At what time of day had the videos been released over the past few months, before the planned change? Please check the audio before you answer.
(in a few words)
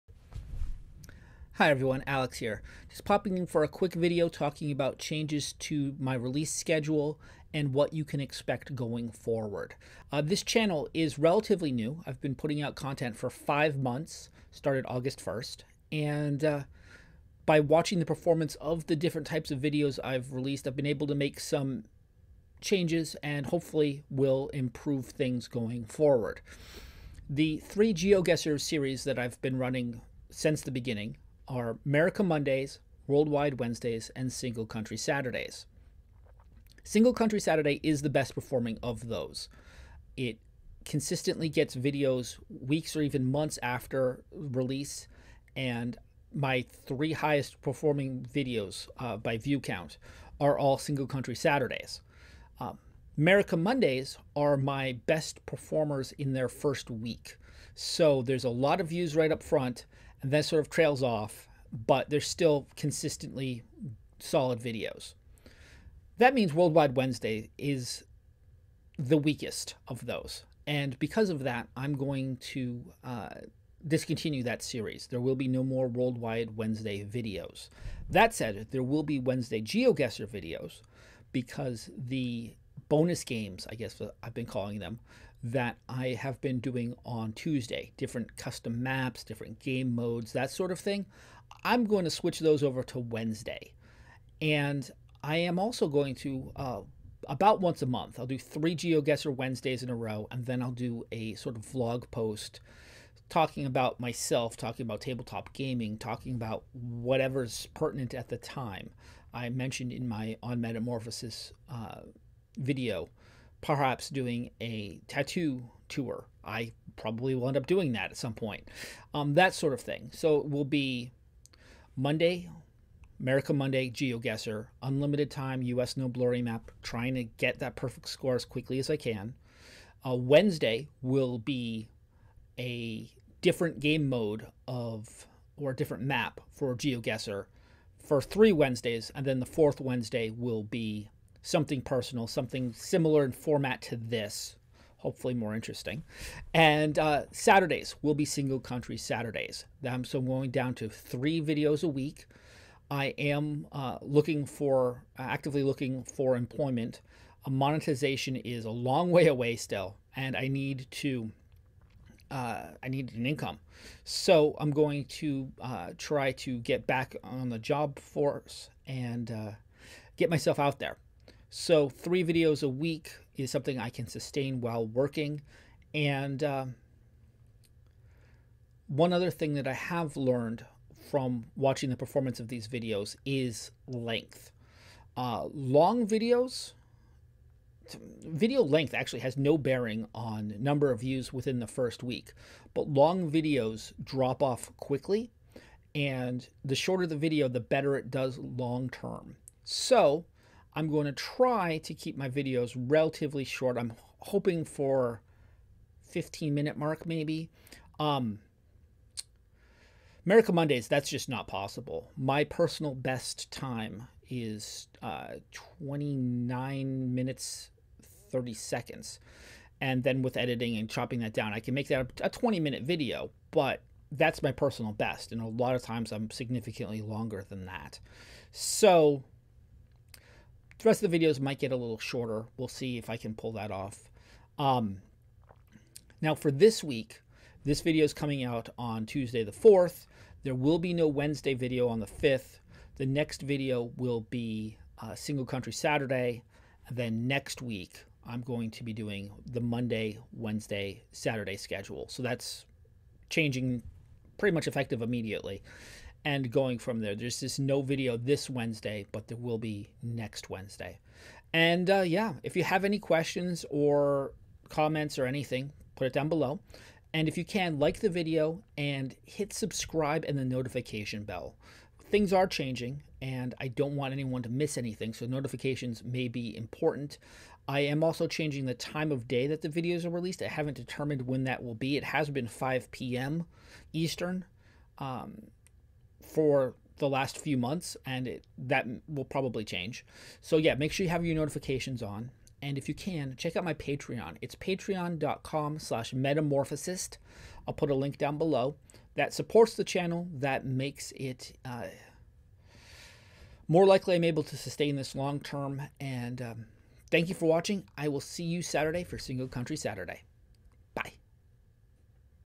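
5 p.m. Eastern.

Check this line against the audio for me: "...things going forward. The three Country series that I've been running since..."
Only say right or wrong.
wrong.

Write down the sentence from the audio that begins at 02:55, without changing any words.
And um, one other thing that I have learned from watching the performance of these videos is length.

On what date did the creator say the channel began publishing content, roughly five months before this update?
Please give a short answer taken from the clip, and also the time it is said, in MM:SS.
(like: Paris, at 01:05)
August 1st, at 00:14.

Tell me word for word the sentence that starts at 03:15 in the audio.
And the shorter the video, the better it does long term.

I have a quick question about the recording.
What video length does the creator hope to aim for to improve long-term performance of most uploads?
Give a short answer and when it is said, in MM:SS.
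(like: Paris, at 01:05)
15 minutes, at 03:26.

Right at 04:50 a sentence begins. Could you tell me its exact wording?
So, yeah, make sure you have your notifications on.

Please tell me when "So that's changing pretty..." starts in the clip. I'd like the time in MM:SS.
04:12.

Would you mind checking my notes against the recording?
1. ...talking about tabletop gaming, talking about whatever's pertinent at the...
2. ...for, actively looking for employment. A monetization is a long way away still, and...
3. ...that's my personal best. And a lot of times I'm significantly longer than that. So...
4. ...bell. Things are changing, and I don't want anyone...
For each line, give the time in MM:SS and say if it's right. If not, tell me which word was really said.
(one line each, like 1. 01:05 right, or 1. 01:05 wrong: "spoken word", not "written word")
1. 01:44 right
2. 02:34 right
3. 03:44 right
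4. 04:31 right.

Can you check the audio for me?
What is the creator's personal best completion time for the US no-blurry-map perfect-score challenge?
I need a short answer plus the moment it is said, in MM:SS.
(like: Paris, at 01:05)
29 minutes 30 seconds, at 03:35.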